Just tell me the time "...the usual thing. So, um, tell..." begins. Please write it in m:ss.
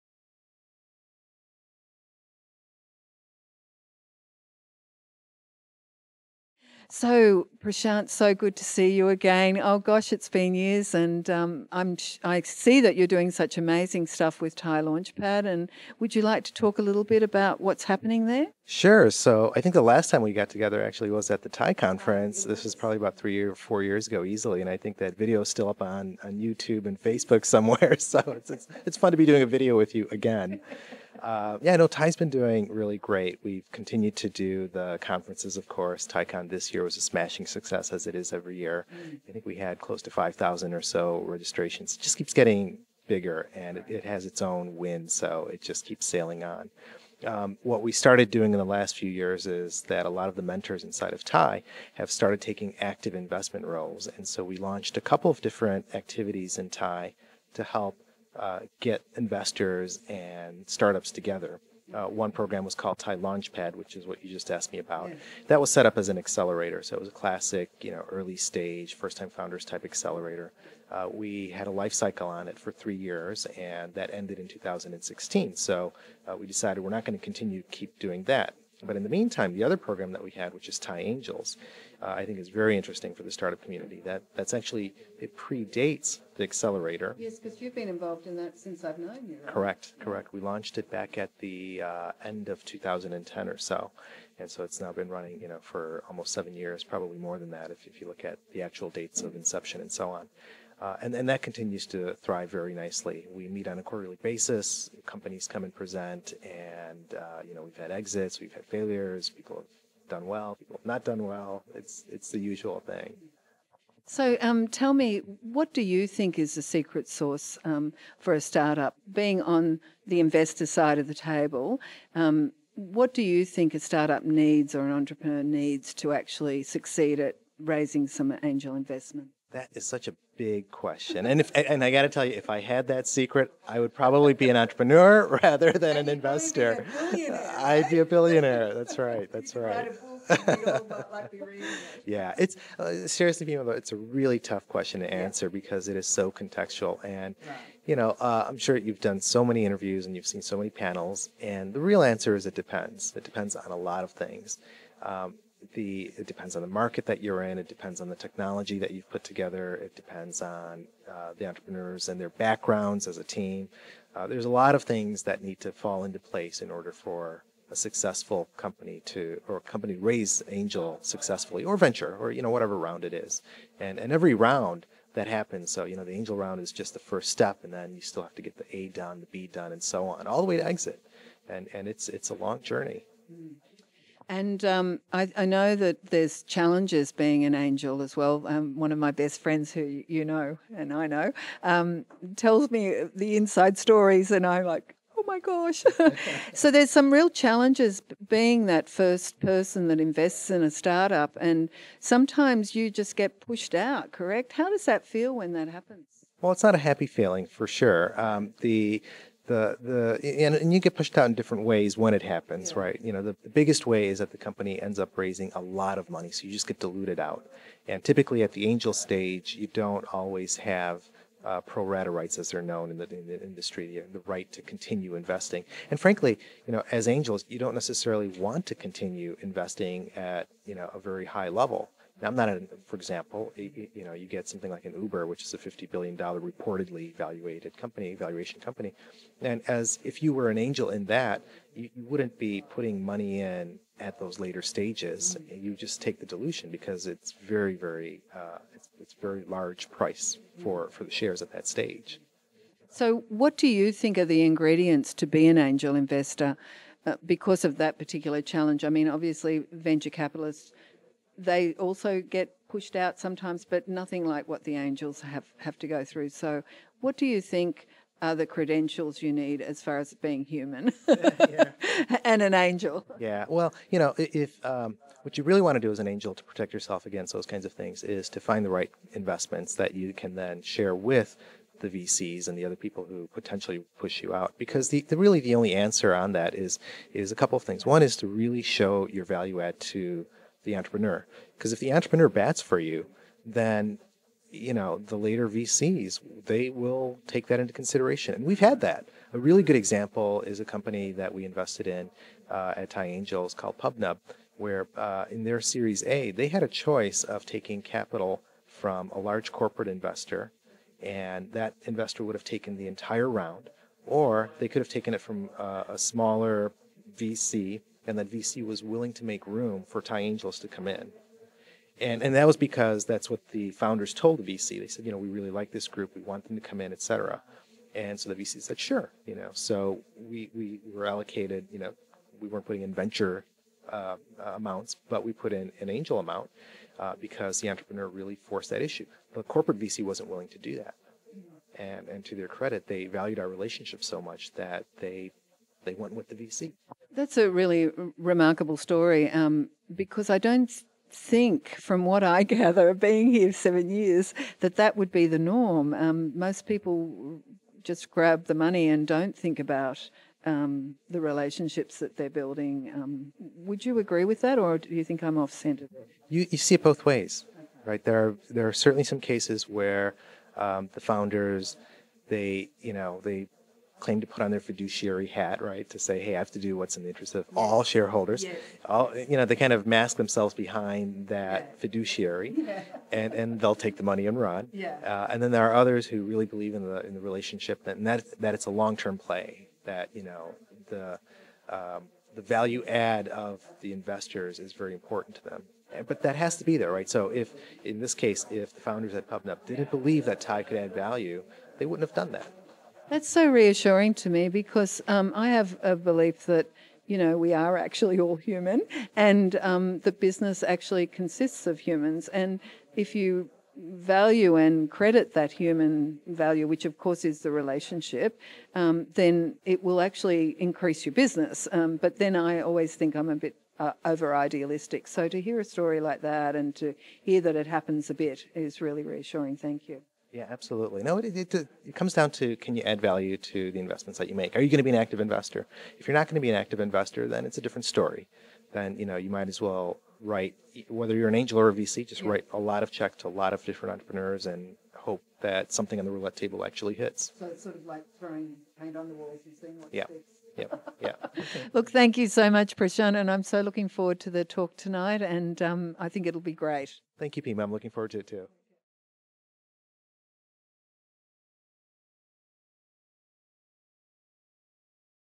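1:52.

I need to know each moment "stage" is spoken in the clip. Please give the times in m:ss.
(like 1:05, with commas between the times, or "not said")
1:08, 3:38, 4:04, 4:11.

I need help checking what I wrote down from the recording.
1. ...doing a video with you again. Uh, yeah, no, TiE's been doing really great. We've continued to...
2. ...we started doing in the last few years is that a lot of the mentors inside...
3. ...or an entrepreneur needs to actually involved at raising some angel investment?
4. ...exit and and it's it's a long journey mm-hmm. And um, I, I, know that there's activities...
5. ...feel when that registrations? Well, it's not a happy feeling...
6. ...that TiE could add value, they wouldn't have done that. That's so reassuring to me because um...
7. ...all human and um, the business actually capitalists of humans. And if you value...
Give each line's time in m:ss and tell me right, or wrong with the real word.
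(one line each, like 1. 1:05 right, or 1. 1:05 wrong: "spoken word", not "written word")
1. 0:29 right
2. 0:47 right
3. 2:04 wrong: "succeed", not "involved"
4. 3:00 wrong: "challenges", not "activities"
5. 3:25 wrong: "happens", not "registrations"
6. 6:40 right
7. 6:48 wrong: "consists", not "capitalists".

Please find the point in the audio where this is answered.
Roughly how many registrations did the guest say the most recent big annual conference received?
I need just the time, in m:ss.
0:40.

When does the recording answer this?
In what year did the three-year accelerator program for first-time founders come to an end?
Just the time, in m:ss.
1:14.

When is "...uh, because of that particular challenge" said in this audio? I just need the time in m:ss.
4:17.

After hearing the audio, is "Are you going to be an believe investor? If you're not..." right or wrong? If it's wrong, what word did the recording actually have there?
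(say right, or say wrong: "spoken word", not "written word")
wrong: "active", not "believe".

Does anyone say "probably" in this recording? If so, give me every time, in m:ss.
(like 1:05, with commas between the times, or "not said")
0:22, 1:36, 2:13.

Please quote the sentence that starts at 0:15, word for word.
And would you like to talk a little bit about what's happening there?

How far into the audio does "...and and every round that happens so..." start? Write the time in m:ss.
2:53.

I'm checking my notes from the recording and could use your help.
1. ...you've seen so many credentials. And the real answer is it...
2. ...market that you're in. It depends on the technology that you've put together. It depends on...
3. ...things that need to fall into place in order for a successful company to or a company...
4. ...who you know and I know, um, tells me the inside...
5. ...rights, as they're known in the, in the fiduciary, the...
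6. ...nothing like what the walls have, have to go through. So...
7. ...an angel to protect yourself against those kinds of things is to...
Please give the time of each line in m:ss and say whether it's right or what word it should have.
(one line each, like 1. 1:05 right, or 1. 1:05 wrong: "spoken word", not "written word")
1. 2:30 wrong: "panels", not "credentials"
2. 2:36 right
3. 2:44 right
4. 3:09 right
5. 3:42 wrong: "industry", not "fiduciary"
6. 4:23 wrong: "angels", not "walls"
7. 4:35 right.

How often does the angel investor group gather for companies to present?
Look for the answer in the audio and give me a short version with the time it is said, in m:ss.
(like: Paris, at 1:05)
Quarterly, at 1:43.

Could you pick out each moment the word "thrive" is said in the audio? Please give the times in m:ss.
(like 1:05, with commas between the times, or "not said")
1:42.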